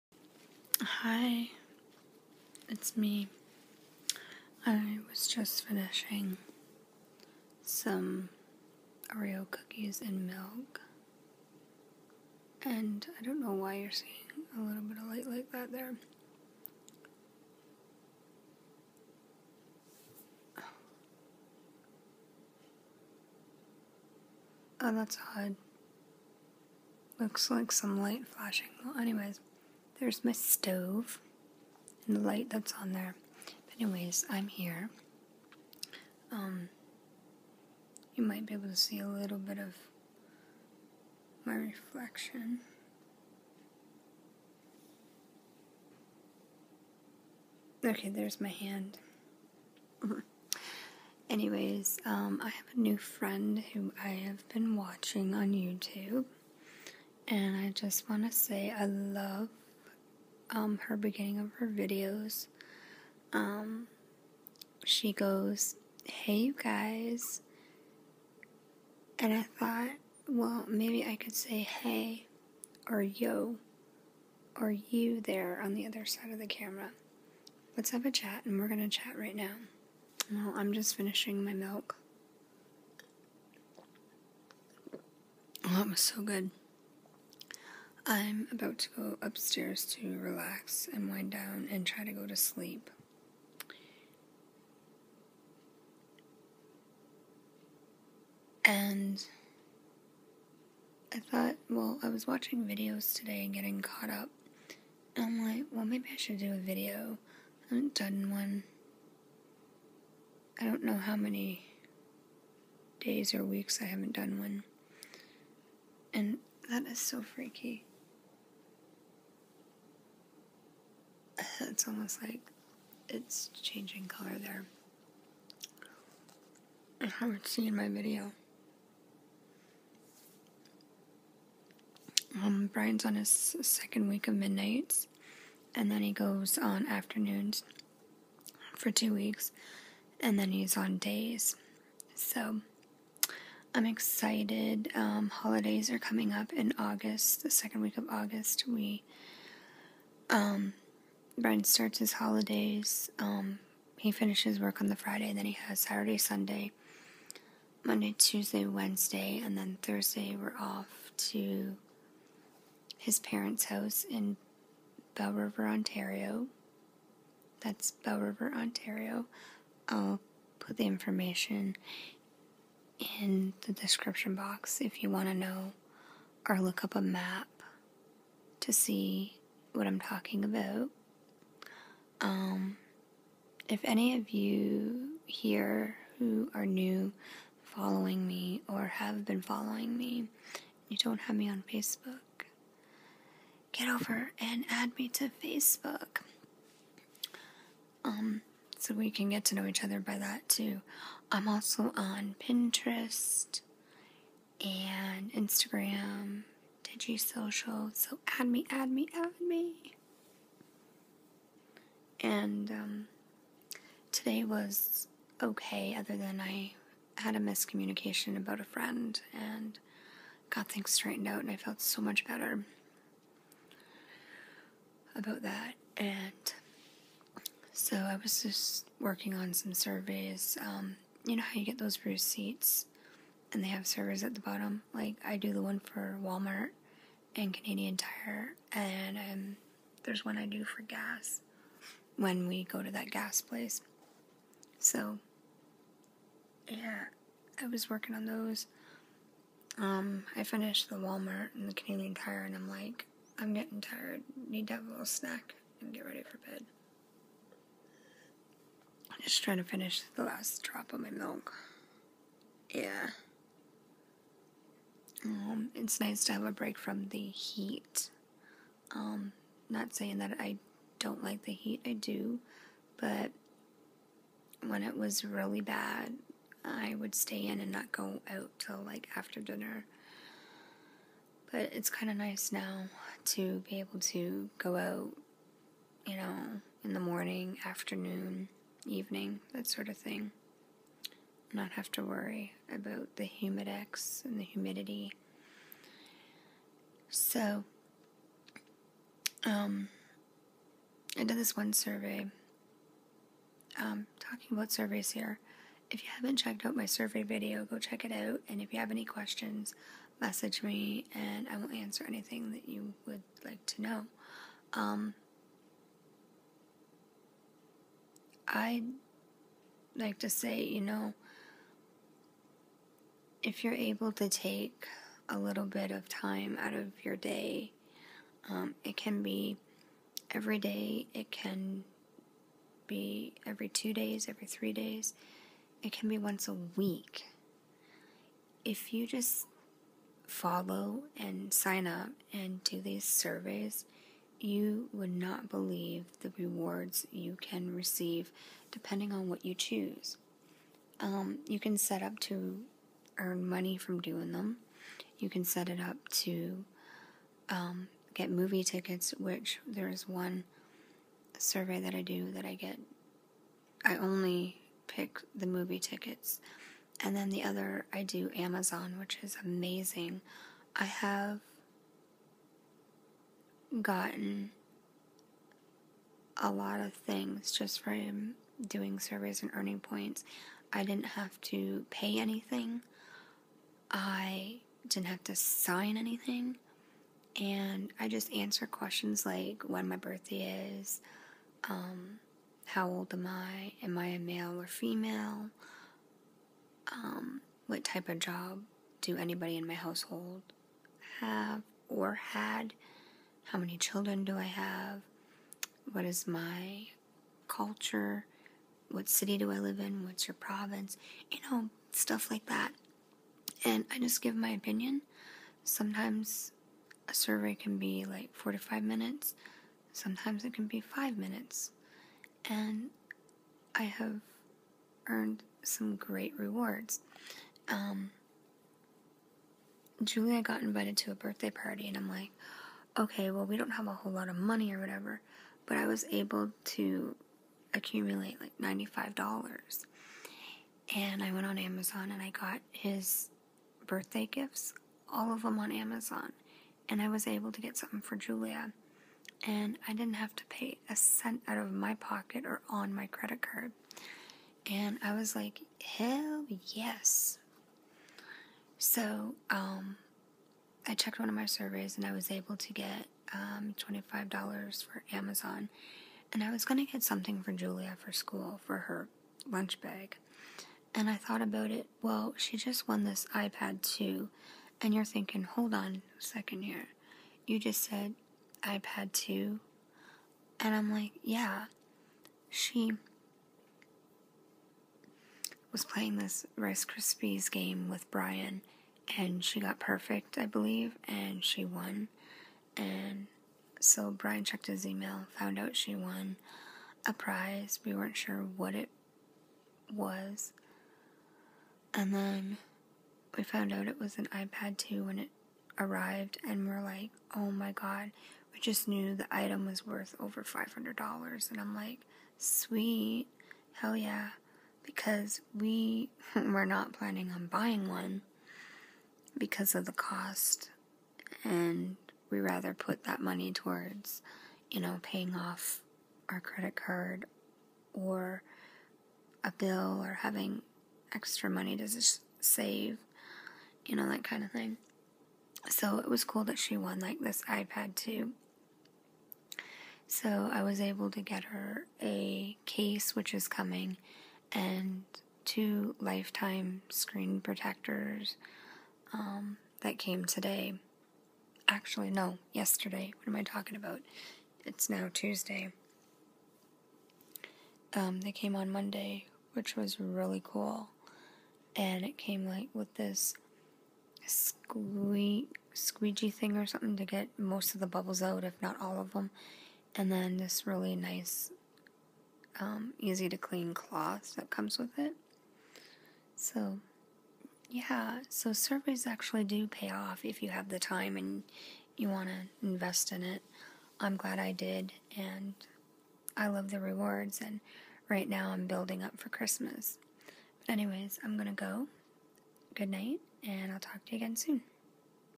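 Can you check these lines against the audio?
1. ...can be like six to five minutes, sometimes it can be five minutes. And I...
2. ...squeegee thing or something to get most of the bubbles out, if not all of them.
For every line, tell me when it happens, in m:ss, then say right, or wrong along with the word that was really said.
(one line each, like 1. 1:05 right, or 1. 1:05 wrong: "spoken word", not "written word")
1. 6:57 wrong: "four", not "six"
2. 9:25 right.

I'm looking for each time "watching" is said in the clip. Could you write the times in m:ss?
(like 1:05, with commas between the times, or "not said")
0:54, 1:42.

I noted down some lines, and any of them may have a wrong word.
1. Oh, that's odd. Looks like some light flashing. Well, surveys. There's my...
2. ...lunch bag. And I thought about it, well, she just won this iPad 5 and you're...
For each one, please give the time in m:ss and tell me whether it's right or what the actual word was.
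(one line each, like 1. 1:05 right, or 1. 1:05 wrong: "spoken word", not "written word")
1. 0:24 wrong: "anyways", not "surveys"
2. 7:49 wrong: "2", not "5".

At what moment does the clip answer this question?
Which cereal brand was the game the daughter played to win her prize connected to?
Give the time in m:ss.
8:06.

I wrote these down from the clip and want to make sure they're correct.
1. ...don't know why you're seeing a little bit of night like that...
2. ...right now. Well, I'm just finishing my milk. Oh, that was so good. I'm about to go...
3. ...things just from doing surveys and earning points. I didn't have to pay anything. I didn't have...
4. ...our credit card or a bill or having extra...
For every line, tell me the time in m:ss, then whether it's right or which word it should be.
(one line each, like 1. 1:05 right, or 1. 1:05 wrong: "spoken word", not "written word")
1. 0:13 wrong: "light", not "night"
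2. 1:19 right
3. 6:16 right
4. 8:46 right.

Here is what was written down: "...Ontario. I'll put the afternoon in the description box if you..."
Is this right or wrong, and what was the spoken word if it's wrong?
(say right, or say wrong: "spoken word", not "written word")
wrong: "information", not "afternoon".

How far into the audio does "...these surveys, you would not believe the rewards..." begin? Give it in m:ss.
5:42.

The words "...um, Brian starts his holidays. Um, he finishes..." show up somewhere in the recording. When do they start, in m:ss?
2:30.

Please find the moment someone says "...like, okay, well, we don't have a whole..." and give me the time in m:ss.
7:12.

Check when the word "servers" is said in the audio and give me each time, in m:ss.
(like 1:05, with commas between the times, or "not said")
3:53.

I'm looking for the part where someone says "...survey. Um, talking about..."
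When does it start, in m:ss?
5:01.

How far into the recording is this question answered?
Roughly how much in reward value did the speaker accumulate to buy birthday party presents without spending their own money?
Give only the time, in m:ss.
7:18.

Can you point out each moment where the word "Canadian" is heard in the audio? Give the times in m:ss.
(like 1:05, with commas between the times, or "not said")
3:57, 4:11.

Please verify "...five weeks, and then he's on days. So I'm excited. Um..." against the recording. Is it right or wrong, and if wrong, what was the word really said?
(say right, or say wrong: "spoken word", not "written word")
wrong: "two", not "five".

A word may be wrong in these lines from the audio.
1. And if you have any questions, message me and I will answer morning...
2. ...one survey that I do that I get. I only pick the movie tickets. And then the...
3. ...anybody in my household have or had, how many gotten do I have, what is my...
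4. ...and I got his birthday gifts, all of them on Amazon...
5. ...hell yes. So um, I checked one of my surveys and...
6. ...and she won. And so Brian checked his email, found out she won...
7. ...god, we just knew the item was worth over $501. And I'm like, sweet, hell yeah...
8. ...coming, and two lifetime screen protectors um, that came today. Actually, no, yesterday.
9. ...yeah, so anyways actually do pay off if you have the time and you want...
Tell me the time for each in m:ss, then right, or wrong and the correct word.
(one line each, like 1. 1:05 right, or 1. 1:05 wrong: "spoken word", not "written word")
1. 5:08 wrong: "anything", not "morning"
2. 6:00 right
3. 6:39 wrong: "children", not "gotten"
4. 7:22 right
5. 7:35 right
6. 8:11 right
7. 8:27 wrong: "500", not "501"
8. 9:03 right
9. 9:37 wrong: "surveys", not "anyways".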